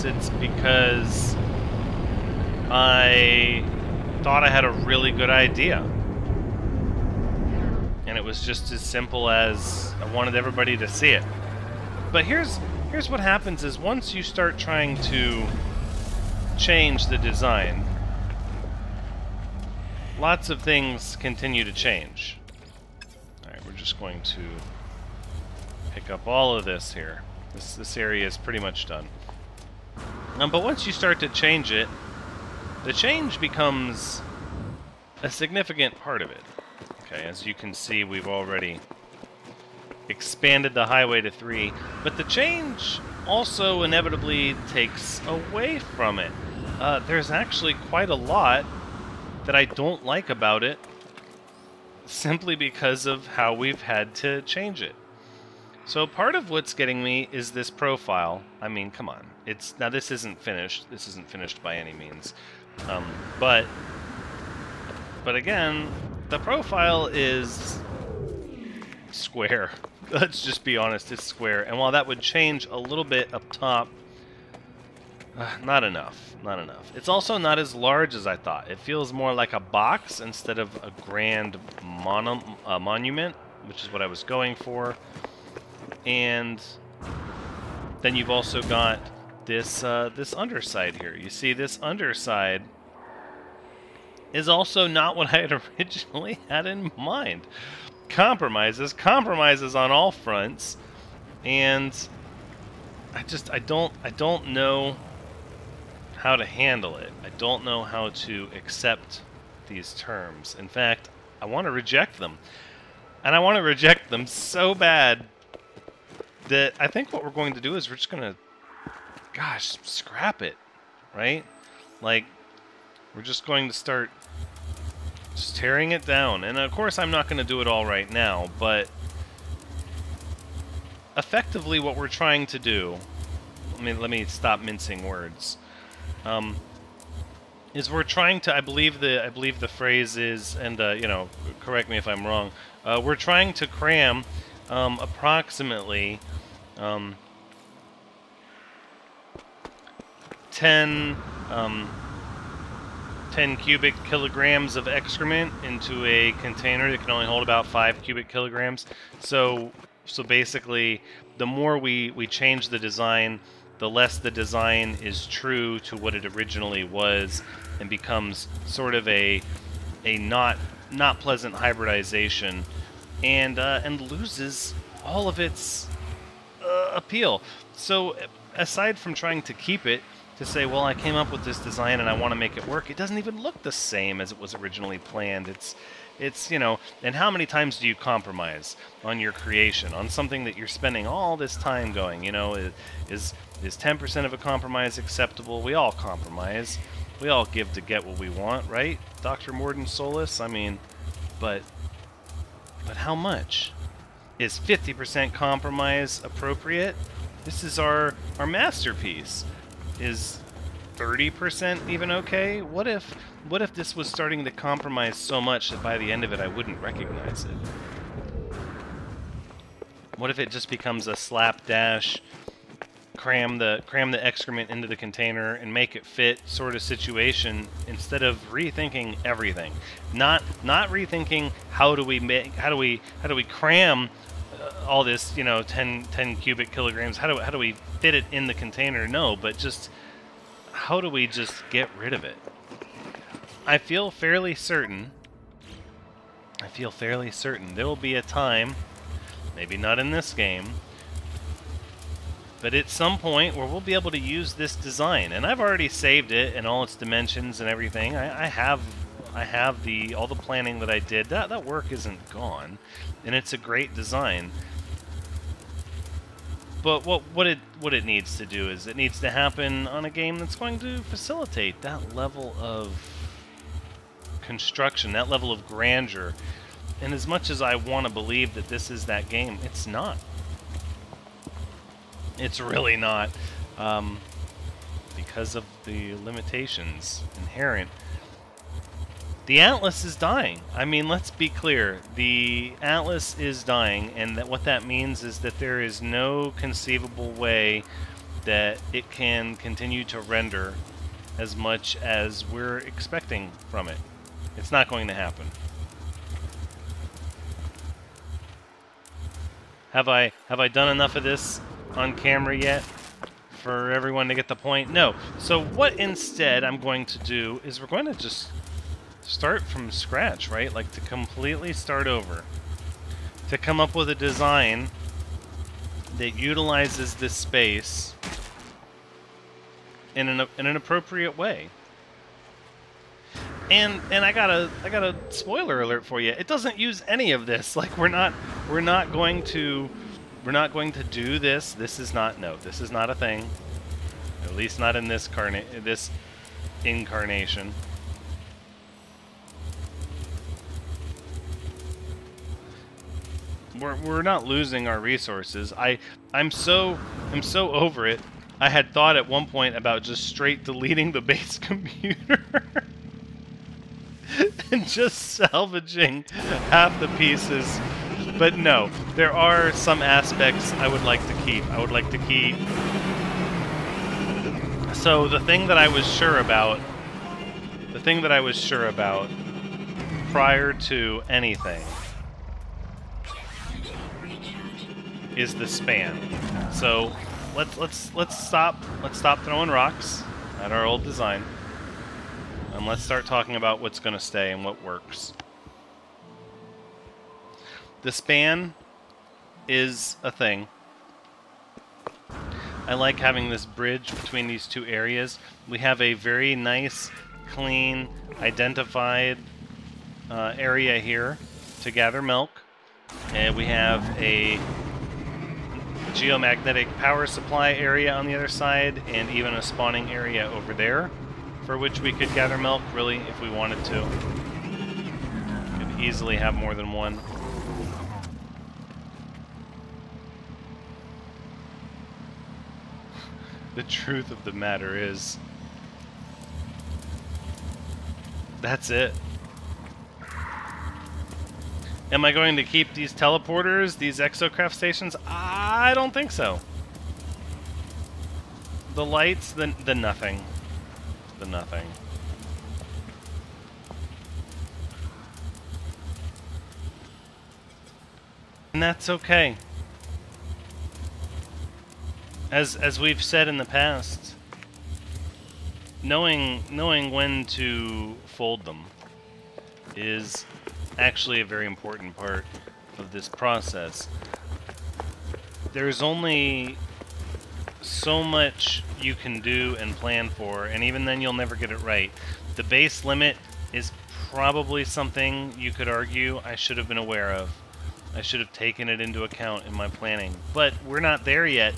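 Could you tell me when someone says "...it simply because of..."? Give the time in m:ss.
0:50.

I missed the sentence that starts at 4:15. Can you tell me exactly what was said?
And I've already saved it and all its dimensions and everything.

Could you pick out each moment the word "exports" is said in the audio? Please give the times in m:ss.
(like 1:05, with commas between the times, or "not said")
not said.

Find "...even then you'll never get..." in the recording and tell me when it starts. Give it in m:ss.
8:00.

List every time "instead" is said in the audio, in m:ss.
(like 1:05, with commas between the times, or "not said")
1:20, 3:47, 5:15.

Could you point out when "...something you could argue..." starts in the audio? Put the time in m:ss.
8:04.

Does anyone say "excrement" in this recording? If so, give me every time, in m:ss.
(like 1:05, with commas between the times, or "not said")
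2:34, 3:44.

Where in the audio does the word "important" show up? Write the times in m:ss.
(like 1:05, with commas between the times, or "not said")
7:51.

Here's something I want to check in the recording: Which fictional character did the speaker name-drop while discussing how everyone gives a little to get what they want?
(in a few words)
Dr. Mordin Solus.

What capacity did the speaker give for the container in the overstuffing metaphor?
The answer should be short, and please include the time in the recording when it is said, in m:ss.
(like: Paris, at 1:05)
5 cubic kilograms, at 2:37.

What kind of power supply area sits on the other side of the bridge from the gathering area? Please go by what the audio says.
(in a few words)
Geomagnetic.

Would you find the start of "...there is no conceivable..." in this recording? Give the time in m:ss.
4:55.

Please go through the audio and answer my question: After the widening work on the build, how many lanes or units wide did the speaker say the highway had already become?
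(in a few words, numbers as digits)
3.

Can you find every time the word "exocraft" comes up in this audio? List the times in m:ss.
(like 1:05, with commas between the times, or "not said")
7:24.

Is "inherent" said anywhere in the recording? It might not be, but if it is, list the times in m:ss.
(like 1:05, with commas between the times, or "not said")
4:47.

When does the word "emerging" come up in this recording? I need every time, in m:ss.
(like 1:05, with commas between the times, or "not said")
not said.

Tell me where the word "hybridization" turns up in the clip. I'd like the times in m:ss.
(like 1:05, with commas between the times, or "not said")
2:51.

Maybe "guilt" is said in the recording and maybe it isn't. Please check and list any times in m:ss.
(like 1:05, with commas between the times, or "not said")
not said.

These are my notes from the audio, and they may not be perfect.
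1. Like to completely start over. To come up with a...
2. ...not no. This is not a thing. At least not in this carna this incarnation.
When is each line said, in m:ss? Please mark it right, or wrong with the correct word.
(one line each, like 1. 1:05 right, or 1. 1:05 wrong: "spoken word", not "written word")
1. 5:20 right
2. 5:42 right.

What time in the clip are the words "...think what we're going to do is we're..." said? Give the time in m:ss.
1:56.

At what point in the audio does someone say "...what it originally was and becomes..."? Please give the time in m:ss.
2:45.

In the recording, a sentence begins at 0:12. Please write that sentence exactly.
But here's here's what happens is once you start trying to change the design, lots of things continue to change.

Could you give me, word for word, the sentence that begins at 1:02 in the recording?
Um, but but again, the profile is square.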